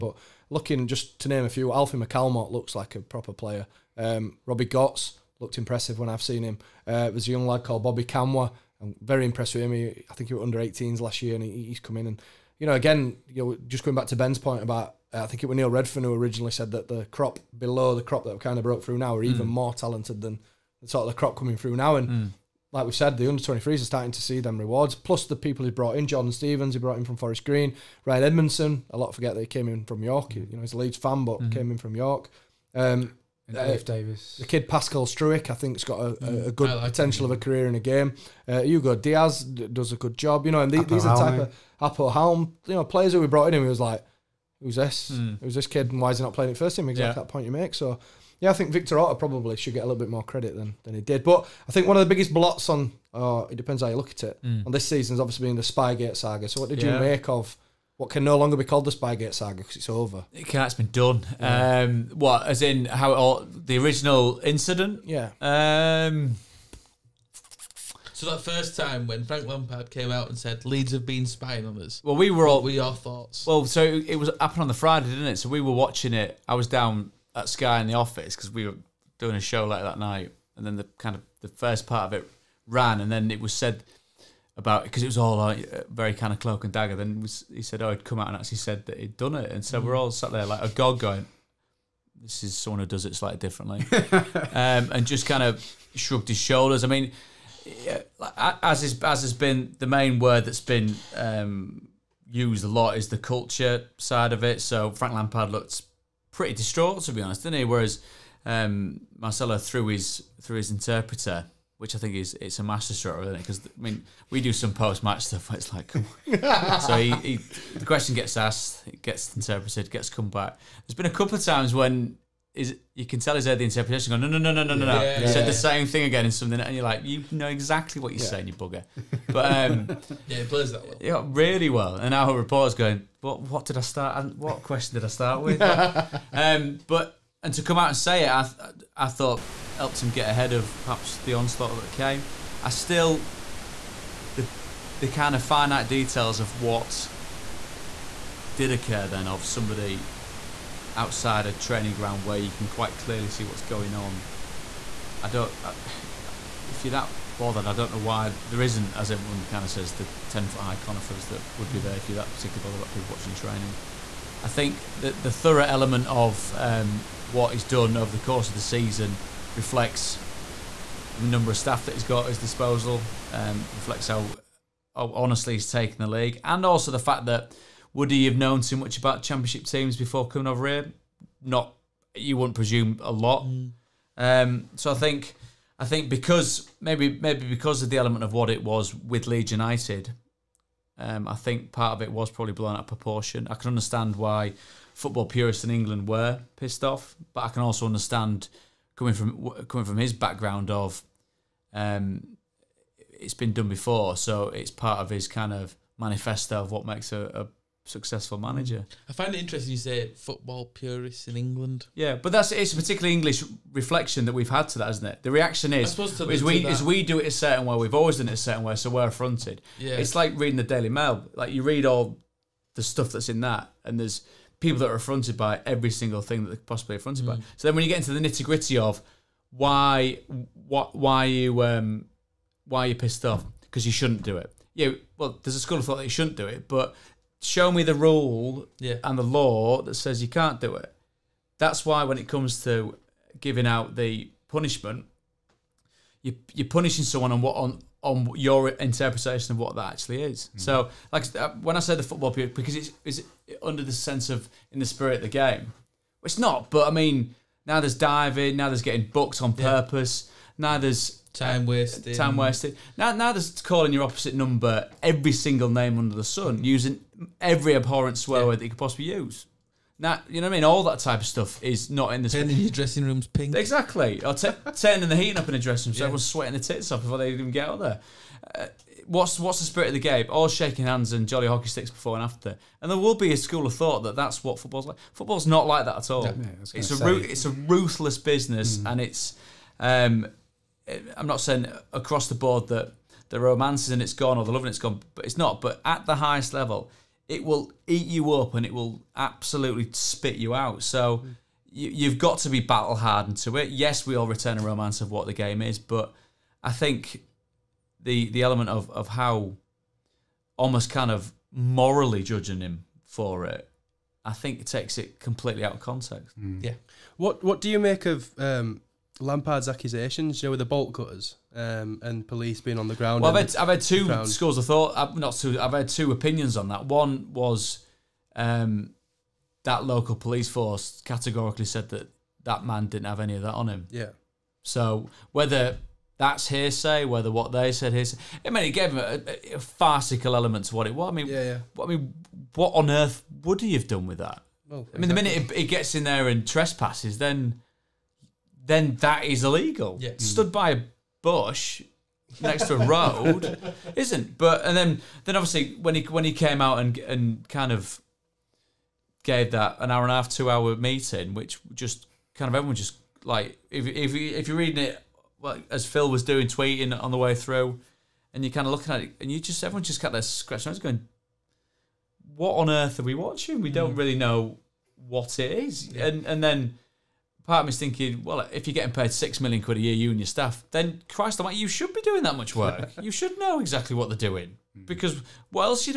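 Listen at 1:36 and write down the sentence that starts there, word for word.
I mean, as is as has been the main word that's been um, used a lot is the culture side of it.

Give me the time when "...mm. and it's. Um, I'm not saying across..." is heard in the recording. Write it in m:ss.
4:48.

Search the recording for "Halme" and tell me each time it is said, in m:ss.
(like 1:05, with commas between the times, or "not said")
0:42.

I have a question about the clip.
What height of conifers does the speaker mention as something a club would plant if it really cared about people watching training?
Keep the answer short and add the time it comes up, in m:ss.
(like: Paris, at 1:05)
10 foot, at 2:40.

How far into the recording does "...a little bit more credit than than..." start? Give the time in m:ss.
0:49.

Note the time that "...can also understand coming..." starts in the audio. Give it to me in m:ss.
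3:17.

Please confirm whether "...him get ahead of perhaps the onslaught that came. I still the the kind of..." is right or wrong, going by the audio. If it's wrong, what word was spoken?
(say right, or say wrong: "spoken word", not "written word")
right.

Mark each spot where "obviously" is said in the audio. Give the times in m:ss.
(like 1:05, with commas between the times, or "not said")
0:55, 5:55.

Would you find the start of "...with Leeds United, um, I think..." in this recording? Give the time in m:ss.
3:08.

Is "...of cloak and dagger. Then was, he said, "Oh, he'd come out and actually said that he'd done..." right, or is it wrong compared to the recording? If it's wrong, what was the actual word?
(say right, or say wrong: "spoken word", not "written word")
right.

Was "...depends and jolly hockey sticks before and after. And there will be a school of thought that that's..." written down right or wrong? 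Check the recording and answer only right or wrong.
wrong.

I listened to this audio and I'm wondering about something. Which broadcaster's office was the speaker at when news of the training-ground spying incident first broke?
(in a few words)
Sky.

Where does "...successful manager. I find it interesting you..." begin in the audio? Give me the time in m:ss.
3:27.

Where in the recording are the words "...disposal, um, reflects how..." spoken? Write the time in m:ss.
2:52.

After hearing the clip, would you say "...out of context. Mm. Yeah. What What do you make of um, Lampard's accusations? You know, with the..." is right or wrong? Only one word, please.
right.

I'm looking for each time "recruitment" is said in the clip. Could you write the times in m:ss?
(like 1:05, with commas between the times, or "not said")
not said.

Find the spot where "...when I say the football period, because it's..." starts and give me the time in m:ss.
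4:11.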